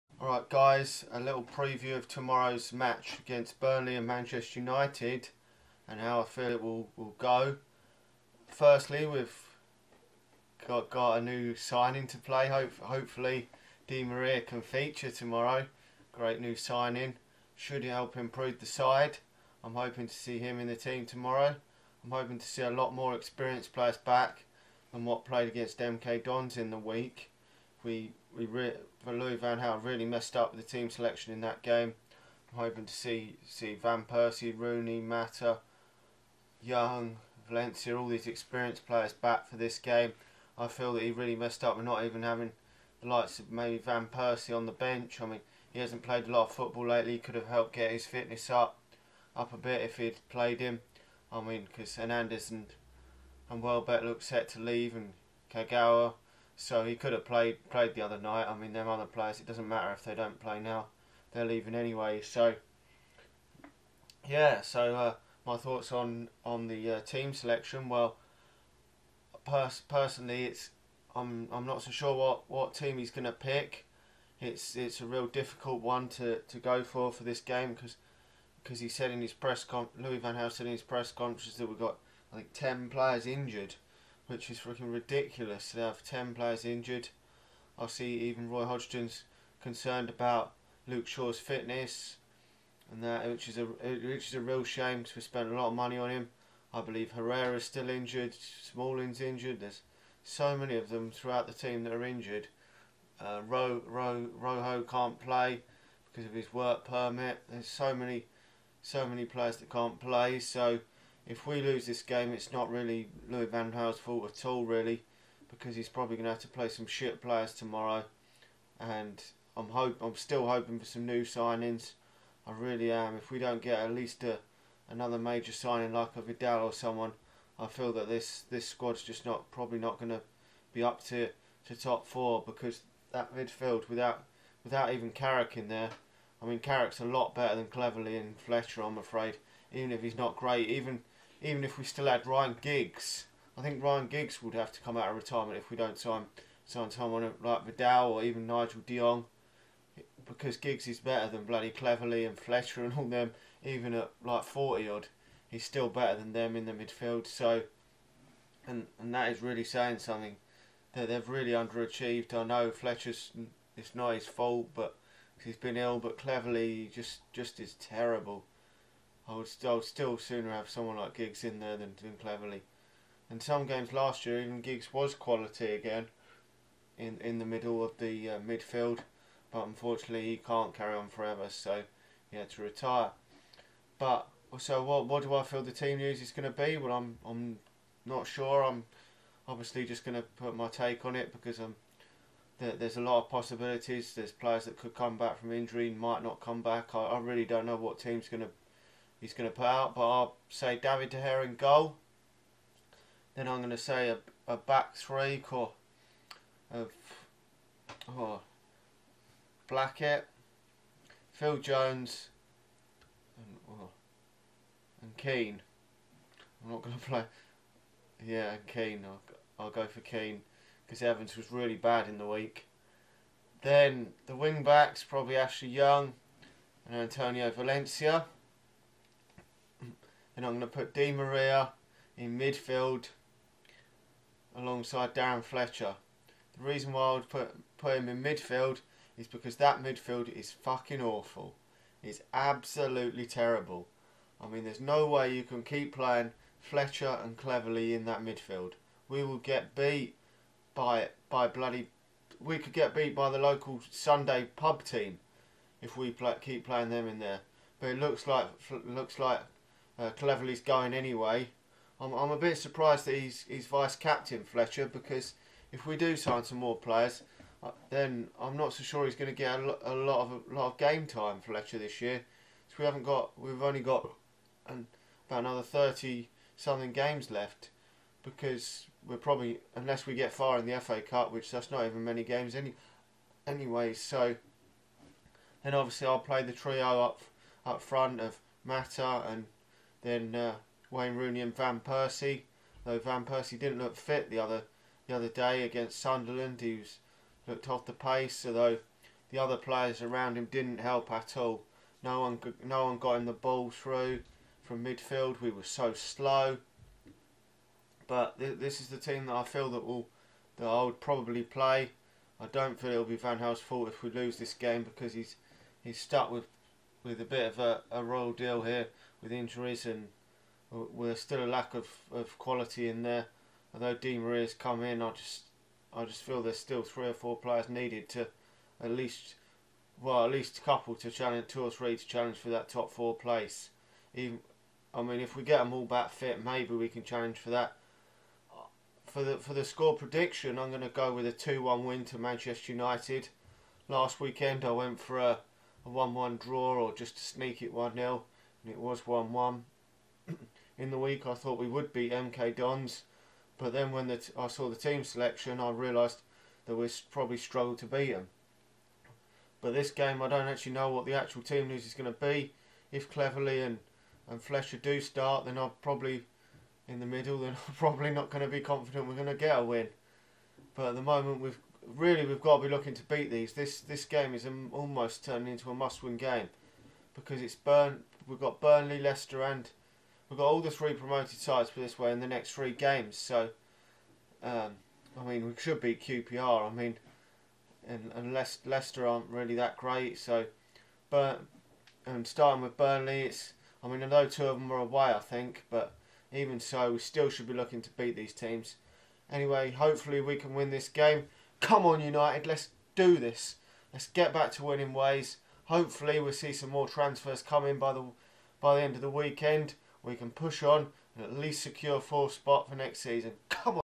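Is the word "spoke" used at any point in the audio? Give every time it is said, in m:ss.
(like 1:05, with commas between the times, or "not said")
not said.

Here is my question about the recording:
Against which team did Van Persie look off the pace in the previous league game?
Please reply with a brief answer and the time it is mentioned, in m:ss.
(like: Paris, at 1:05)
Sunderland, at 4:55.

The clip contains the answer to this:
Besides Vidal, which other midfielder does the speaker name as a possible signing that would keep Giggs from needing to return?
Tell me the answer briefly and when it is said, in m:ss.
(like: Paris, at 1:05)
Nigel De Jong, at 2:28.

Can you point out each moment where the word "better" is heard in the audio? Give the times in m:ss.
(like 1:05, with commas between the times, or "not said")
2:17, 2:30, 2:35.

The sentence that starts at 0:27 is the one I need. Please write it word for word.
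We we Louis Van Gaal really messed up the team selection in that game.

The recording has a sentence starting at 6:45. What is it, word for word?
Hopefully, we'll see some more transfers coming by the by the end of the weekend.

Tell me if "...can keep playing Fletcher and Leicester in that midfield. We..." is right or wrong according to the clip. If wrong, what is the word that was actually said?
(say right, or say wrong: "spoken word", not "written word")
wrong: "Cleverley", not "Leicester".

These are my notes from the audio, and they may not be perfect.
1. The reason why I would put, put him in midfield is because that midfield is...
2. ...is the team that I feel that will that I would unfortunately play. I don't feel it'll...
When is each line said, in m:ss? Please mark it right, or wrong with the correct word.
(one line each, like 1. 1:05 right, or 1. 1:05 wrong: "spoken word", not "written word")
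1. 3:56 right
2. 5:08 wrong: "probably", not "unfortunately".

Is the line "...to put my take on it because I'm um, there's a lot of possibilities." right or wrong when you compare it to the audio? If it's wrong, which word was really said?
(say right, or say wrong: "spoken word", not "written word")
right.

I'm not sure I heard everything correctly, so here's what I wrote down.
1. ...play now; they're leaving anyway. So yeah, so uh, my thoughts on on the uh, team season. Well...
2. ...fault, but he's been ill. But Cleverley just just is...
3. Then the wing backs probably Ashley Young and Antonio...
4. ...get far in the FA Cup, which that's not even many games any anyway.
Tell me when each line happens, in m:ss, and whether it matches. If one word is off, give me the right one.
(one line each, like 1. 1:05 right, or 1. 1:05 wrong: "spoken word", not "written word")
1. 1:00 wrong: "selection", not "season"
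2. 2:44 right
3. 3:43 right
4. 4:40 right.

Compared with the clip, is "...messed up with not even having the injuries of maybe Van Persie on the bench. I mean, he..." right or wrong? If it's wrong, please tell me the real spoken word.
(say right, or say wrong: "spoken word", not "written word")
wrong: "likes", not "injuries".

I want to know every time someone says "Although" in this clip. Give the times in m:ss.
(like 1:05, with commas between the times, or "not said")
4:58, 5:23.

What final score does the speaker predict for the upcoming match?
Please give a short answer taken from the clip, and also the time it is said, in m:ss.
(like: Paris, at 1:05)
2-1 to Manchester United, at 5:41.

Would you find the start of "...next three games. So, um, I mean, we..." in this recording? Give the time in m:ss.
6:22.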